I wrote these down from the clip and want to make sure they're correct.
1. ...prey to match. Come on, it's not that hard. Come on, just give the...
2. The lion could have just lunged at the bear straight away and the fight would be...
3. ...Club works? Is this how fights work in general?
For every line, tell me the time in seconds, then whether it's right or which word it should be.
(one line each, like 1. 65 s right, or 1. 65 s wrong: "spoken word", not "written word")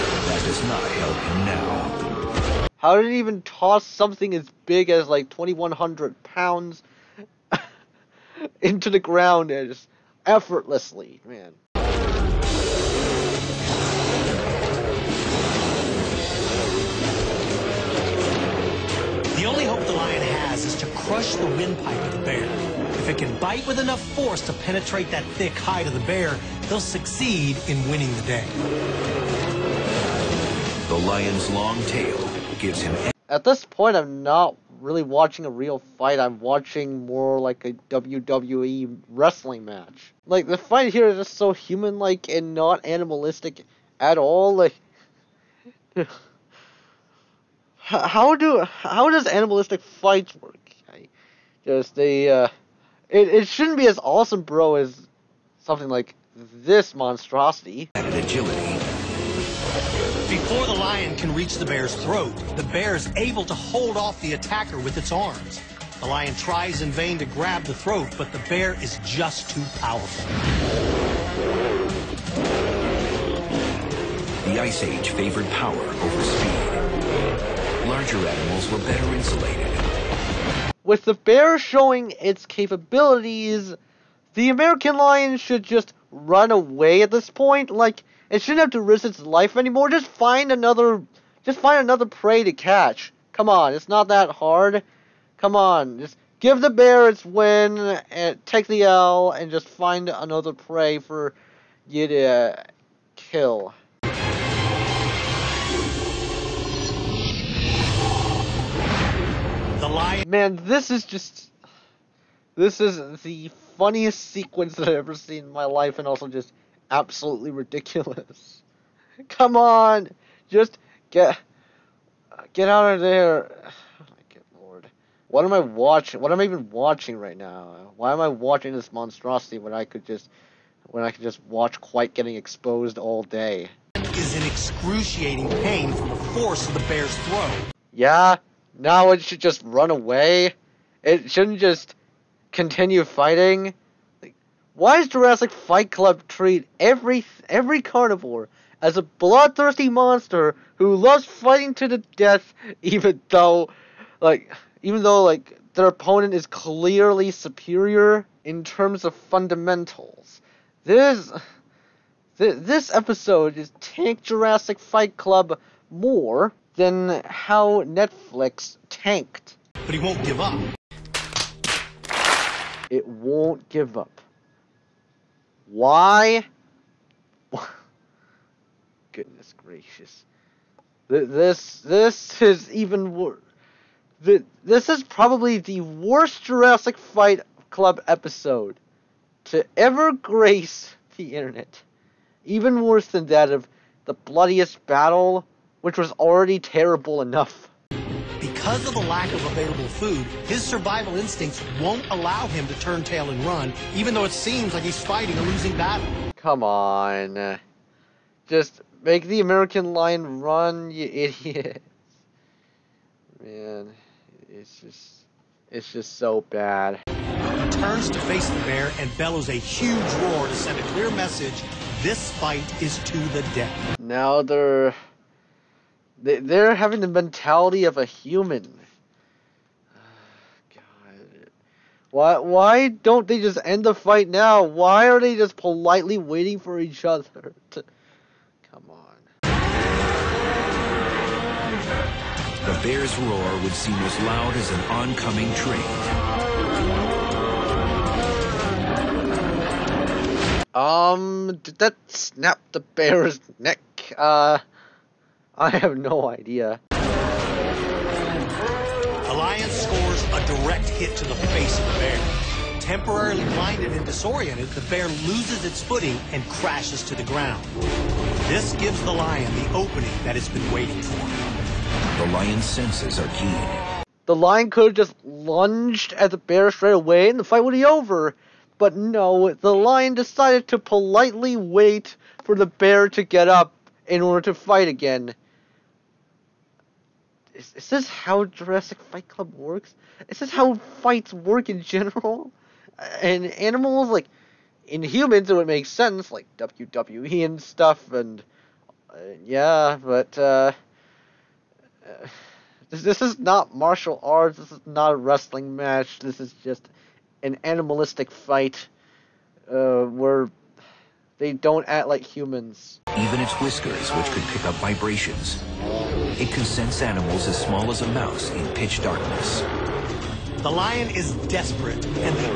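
1. 92 s wrong: "catch", not "match"
2. 274 s right
3. 289 s right.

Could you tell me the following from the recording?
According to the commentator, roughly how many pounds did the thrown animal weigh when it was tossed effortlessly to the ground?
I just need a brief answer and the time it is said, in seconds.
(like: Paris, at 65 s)
2,100 pounds, at 5 s.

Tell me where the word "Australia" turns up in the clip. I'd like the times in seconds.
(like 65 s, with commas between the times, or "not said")
not said.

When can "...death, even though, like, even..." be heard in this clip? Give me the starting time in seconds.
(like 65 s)
152 s.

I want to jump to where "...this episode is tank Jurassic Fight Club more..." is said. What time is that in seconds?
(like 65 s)
162 s.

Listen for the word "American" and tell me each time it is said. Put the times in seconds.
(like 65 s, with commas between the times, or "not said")
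84 s, 209 s.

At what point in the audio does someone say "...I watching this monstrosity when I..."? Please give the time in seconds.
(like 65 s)
128 s.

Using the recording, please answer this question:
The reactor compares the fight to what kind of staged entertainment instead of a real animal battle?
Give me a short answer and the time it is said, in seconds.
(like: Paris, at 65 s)
WWE wrestling match, at 37 s.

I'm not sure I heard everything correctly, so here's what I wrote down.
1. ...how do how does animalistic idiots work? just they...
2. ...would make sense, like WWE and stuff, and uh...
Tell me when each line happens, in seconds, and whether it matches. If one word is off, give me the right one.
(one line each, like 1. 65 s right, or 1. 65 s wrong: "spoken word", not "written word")
1. 47 s wrong: "fights", not "idiots"
2. 295 s right.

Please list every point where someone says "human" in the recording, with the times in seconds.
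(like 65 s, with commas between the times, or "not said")
41 s, 228 s, 295 s, 312 s.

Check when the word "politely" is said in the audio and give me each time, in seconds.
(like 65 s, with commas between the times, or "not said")
235 s, 280 s.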